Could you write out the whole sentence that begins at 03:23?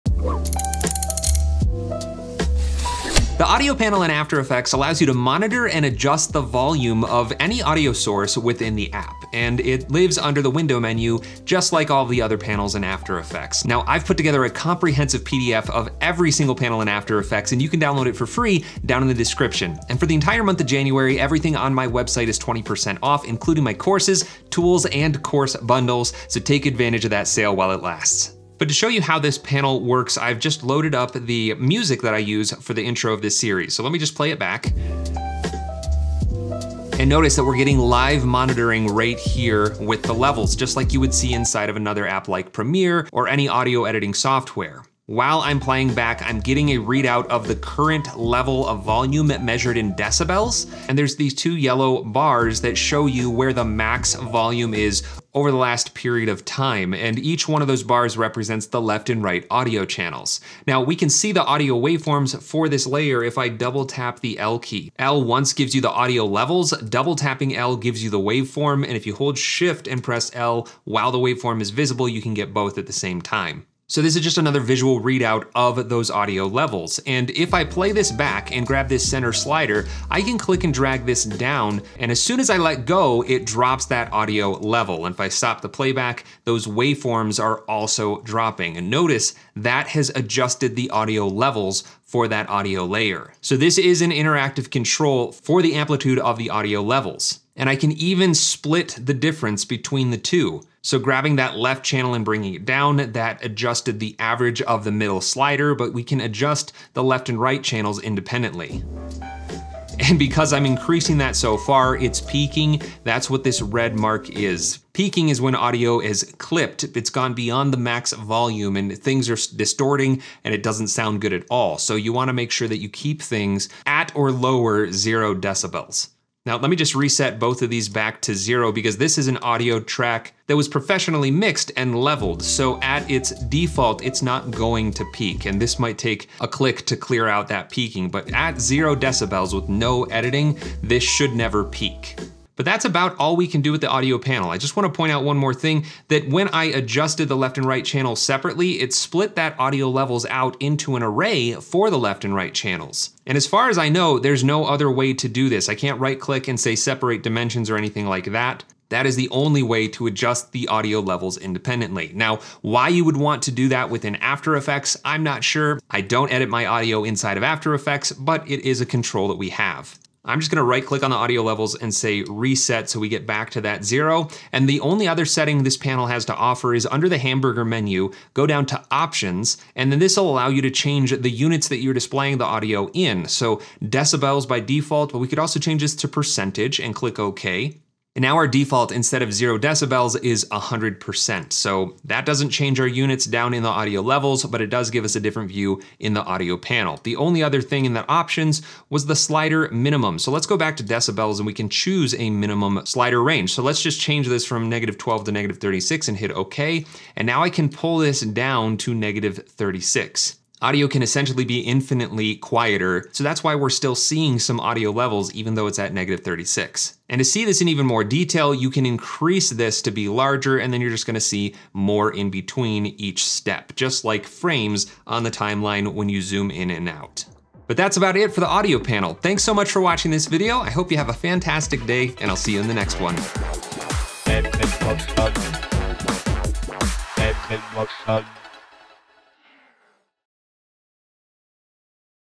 So let's just change this from negative 12 to negative 36 and hit okay.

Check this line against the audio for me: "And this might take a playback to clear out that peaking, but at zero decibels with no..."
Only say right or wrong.
wrong.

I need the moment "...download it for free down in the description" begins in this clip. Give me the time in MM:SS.
00:17.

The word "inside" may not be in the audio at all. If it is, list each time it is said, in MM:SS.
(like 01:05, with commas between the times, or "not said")
00:41, 02:47.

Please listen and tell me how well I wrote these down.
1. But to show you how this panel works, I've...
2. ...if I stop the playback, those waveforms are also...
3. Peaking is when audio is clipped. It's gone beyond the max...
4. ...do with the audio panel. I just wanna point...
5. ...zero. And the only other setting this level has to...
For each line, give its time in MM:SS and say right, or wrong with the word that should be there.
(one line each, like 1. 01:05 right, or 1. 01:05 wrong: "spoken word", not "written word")
1. 00:28 right
2. 01:25 right
3. 01:54 right
4. 02:23 right
5. 02:53 wrong: "panel", not "level".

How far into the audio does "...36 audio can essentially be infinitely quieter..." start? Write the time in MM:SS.
03:29.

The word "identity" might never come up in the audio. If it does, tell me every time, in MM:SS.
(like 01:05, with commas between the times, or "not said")
not said.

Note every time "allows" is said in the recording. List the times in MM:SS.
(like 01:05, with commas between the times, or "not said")
00:04, 03:00.